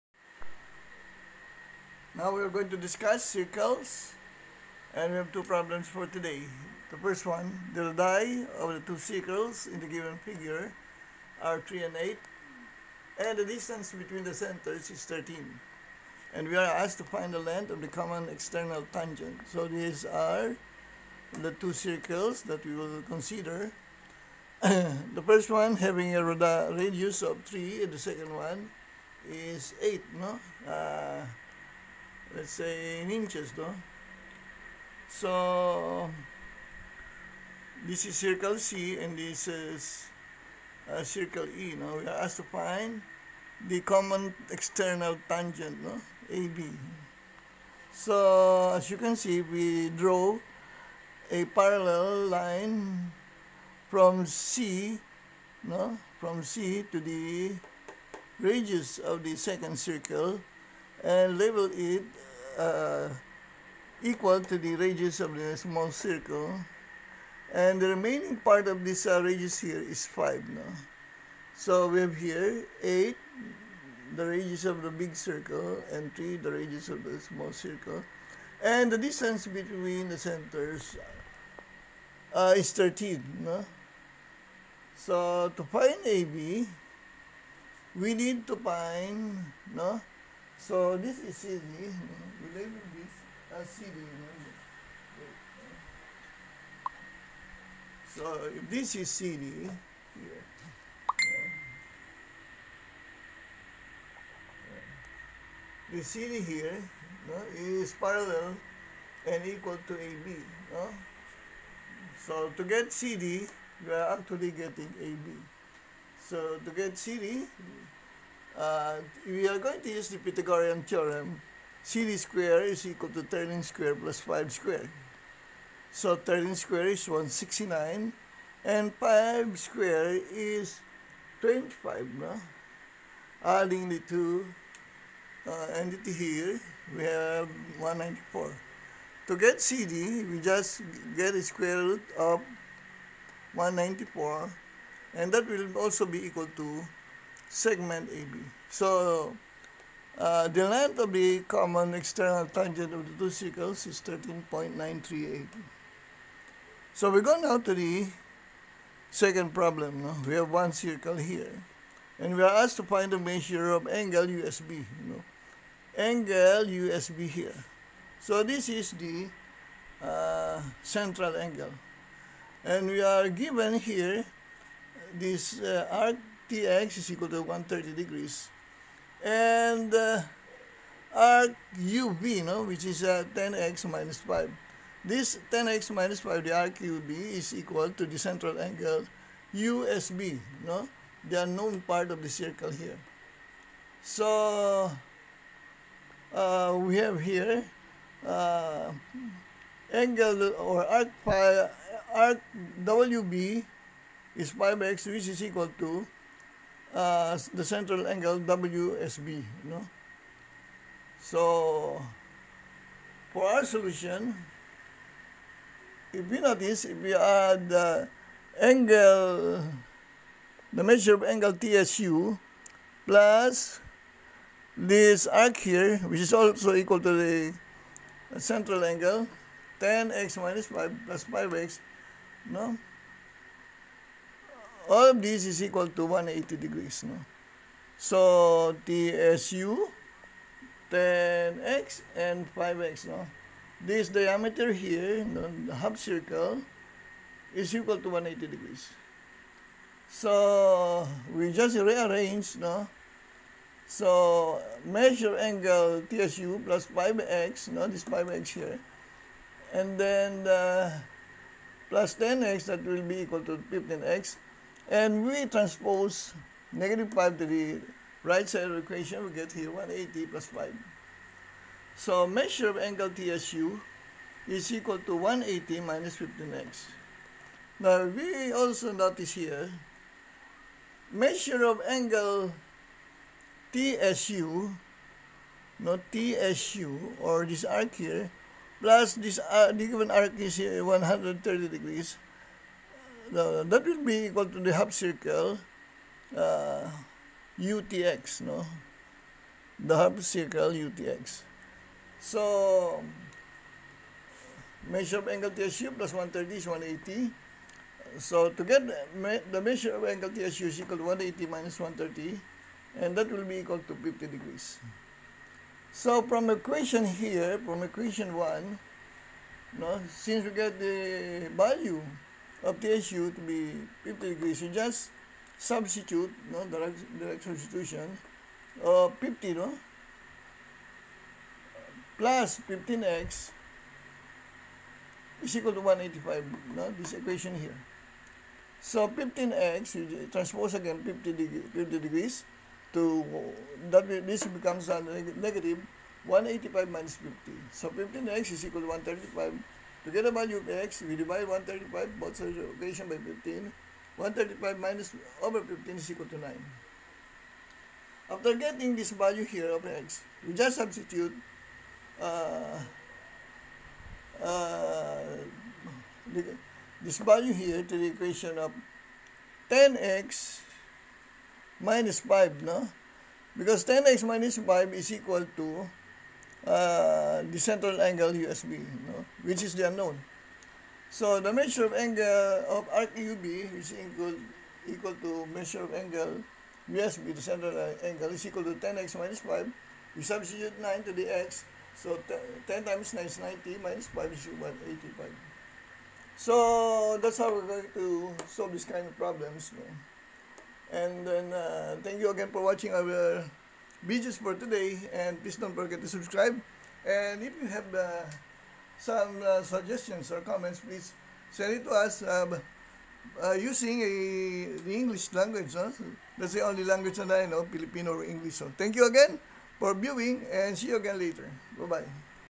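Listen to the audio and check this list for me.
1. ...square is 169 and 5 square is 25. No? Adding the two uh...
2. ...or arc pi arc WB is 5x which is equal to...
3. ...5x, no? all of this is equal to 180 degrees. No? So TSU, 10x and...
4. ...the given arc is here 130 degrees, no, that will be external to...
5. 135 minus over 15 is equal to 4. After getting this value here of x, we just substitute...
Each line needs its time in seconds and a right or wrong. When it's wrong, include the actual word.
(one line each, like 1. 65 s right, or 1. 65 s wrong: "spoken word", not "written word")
1. 126 s right
2. 200 s right
3. 231 s right
4. 289 s wrong: "equal", not "external"
5. 354 s wrong: "9", not "4".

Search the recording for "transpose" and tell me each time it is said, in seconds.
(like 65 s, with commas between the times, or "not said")
265 s, 340 s.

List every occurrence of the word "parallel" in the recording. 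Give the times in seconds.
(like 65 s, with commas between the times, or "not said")
51 s, 107 s.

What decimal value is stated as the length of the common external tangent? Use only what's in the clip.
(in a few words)
13.938.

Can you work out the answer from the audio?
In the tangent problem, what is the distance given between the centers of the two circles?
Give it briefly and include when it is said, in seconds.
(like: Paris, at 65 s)
13, at 13 s.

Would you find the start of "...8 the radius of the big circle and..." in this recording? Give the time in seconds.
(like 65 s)
72 s.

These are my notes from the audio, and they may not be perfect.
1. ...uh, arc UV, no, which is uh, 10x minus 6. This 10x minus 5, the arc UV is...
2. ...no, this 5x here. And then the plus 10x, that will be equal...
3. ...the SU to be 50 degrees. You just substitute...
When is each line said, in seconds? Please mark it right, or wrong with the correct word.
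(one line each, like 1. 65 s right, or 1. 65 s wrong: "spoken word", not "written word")
1. 179 s wrong: "5", not "6"
2. 257 s right
3. 322 s right.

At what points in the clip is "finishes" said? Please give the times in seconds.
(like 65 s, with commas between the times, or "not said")
not said.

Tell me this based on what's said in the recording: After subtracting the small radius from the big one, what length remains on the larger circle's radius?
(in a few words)
5.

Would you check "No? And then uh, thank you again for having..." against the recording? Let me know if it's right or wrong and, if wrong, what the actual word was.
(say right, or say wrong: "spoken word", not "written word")
wrong: "watching", not "having".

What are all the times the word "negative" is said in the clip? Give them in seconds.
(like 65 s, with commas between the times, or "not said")
266 s, 345 s.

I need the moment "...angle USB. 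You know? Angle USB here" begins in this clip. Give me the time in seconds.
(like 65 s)
163 s.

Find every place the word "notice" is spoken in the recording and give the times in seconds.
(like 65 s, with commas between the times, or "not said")
216 s, 278 s.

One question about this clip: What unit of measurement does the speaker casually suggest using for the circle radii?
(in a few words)
inches.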